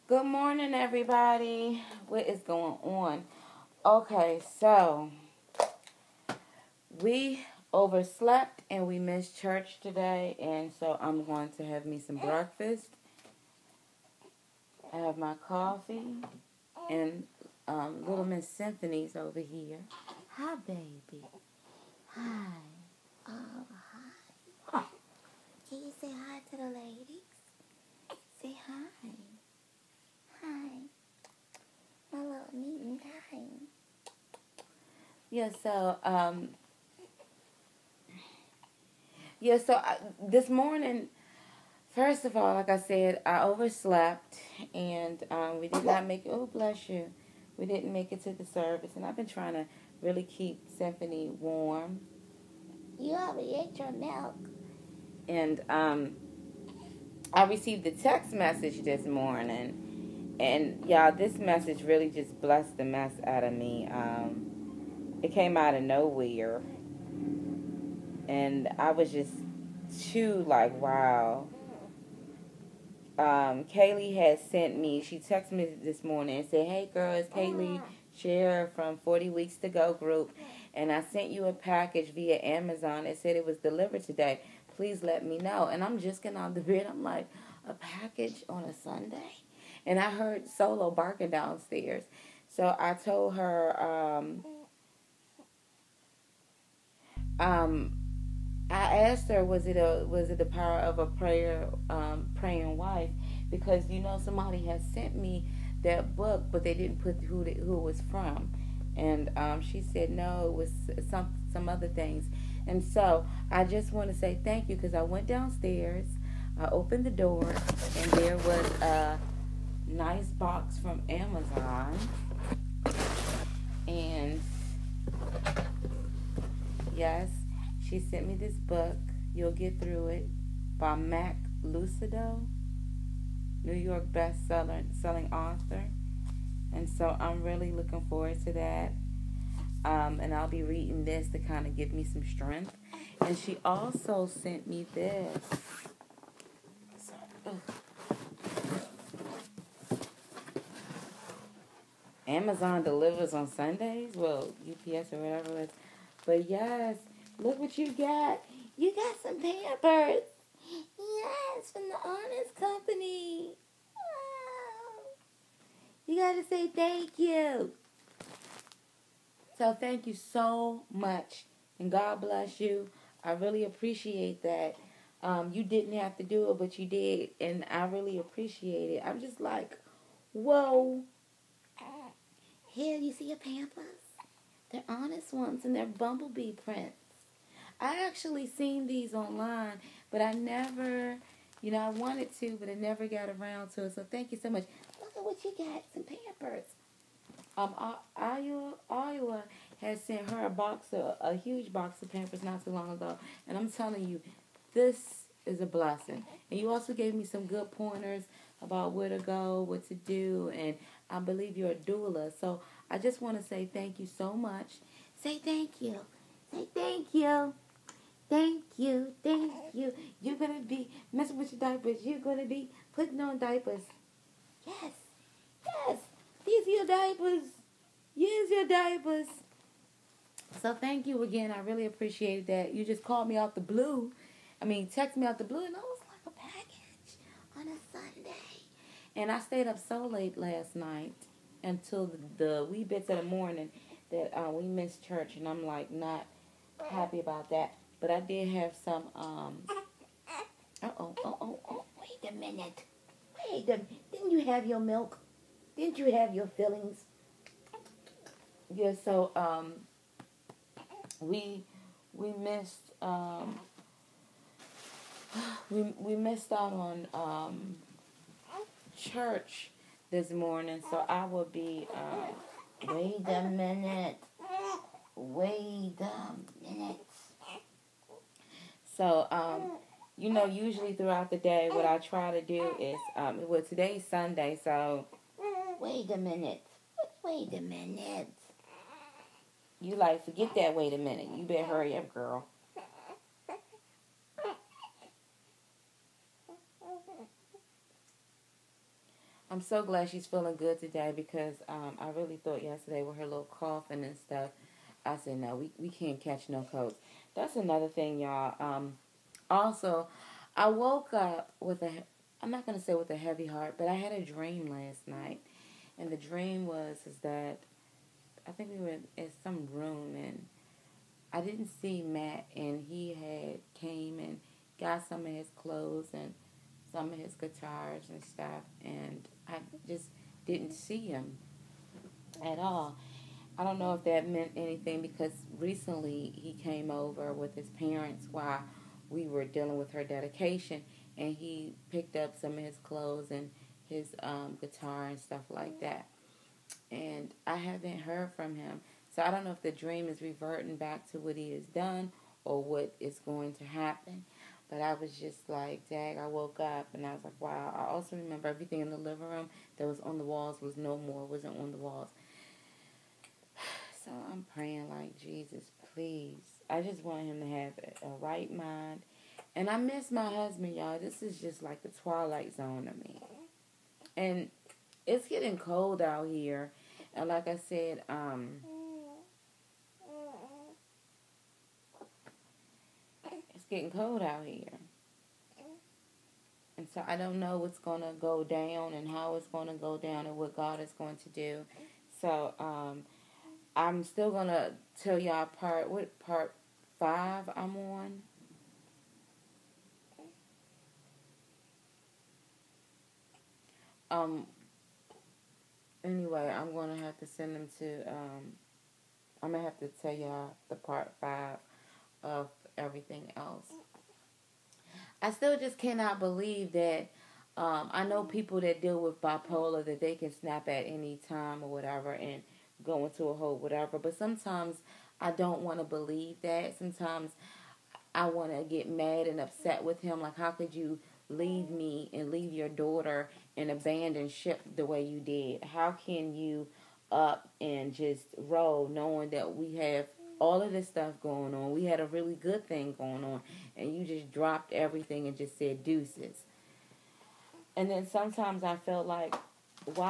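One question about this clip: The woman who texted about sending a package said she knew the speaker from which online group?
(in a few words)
40 Weeks to Go.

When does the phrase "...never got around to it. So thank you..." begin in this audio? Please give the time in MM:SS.
03:12.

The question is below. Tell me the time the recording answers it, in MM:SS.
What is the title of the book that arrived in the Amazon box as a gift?
02:09.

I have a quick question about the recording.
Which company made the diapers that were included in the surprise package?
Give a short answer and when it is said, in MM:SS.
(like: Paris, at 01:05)
Honest Company, at 02:42.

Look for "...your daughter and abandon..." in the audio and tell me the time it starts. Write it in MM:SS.
07:12.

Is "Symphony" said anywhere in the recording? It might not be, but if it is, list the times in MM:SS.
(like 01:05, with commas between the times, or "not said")
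00:18, 00:50.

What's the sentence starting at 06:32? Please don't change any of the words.
So um, I'm still going to tell y'all part, what part five I'm on.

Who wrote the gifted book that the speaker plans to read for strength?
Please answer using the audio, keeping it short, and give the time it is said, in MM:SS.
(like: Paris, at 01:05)
Max Lucado, at 02:10.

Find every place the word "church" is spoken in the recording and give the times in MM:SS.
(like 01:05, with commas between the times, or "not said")
00:09, 04:05, 04:28.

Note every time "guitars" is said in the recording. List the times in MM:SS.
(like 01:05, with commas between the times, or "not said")
05:27, 05:44.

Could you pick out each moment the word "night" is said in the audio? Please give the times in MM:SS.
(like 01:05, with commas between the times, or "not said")
04:00, 05:15.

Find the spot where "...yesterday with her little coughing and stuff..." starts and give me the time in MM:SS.
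05:02.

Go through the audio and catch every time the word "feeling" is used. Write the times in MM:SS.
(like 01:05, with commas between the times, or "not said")
05:00.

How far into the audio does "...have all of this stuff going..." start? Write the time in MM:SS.
07:19.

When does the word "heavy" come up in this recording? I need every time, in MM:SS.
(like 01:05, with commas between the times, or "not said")
05:13.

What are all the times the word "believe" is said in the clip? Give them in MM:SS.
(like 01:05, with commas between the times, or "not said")
03:31, 06:56, 07:05.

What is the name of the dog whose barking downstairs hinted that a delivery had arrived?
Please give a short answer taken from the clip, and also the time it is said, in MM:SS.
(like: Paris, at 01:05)
Solo, at 01:30.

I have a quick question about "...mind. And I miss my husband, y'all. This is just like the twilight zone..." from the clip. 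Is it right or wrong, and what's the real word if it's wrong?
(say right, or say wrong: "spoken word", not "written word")
right.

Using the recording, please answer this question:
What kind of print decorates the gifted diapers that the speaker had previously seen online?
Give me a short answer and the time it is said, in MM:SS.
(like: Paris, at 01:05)
Bumblebee, at 03:05.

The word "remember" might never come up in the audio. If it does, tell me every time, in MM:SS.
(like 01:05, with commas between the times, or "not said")
05:58.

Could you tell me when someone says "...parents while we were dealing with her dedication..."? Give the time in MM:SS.
05:37.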